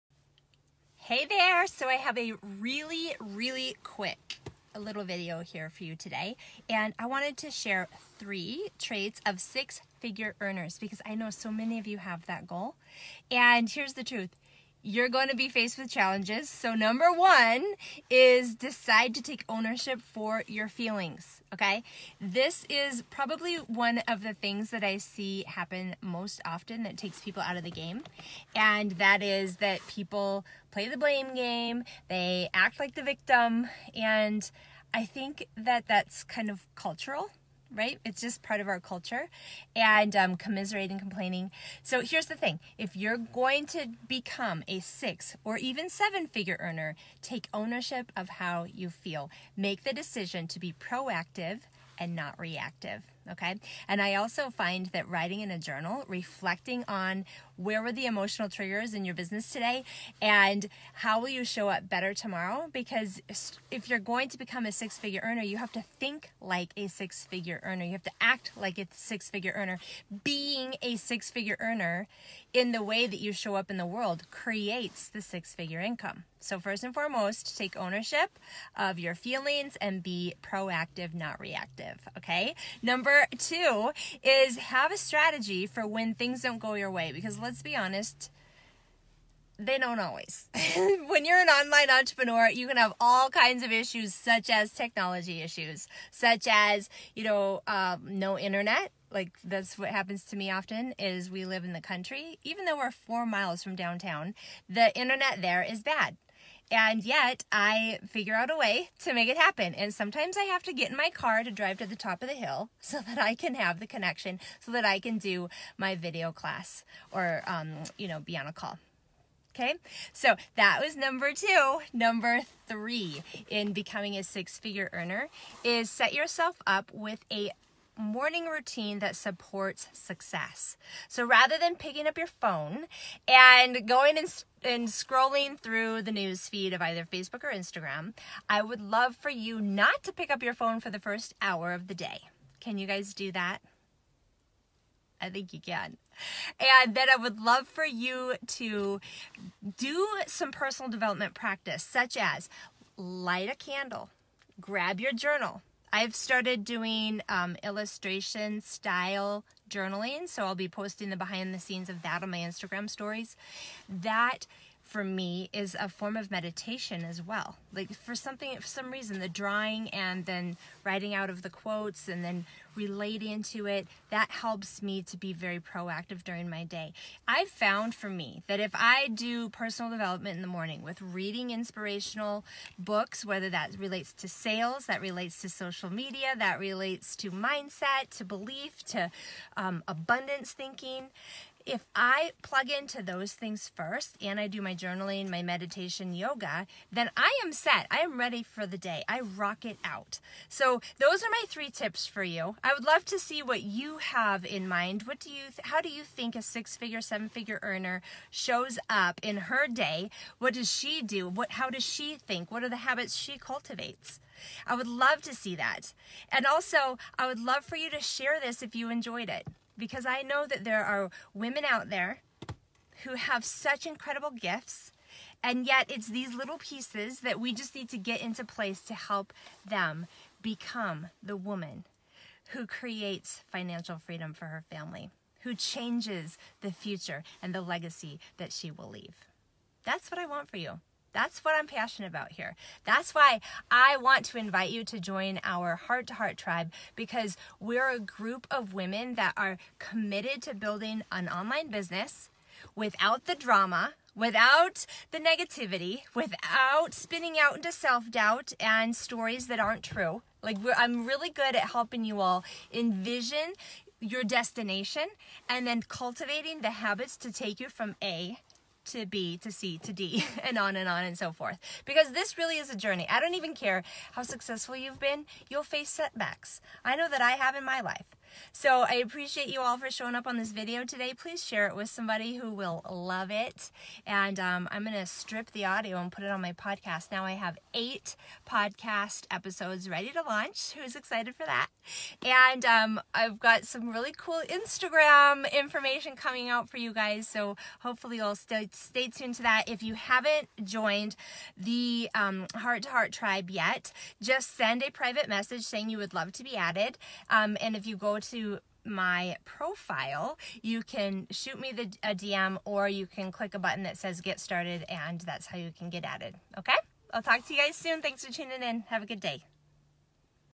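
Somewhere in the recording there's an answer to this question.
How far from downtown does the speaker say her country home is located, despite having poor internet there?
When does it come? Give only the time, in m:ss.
1:42.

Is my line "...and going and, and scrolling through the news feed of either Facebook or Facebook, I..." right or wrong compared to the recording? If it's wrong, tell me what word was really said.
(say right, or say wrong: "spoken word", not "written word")
wrong: "Instagram", not "Facebook".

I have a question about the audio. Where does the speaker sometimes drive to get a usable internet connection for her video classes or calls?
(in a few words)
top of the hill.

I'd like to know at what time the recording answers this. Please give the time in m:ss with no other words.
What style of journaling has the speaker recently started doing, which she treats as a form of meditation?
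2:37.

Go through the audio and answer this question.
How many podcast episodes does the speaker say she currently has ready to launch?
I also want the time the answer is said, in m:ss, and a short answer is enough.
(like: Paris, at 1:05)
8, at 4:47.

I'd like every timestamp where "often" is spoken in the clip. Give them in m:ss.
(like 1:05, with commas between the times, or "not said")
0:26, 1:40.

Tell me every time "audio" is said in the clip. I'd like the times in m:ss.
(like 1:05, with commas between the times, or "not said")
4:45.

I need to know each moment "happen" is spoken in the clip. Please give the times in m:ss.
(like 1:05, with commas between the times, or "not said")
0:25, 1:39, 1:49.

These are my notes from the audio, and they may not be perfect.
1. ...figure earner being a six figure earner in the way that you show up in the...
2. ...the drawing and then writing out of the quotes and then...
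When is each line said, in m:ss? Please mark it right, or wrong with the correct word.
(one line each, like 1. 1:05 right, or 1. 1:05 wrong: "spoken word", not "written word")
1. 1:09 right
2. 2:49 right.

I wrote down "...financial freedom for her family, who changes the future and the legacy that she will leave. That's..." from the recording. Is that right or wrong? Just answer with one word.
right.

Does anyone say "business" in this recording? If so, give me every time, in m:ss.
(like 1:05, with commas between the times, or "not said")
0:59, 4:11.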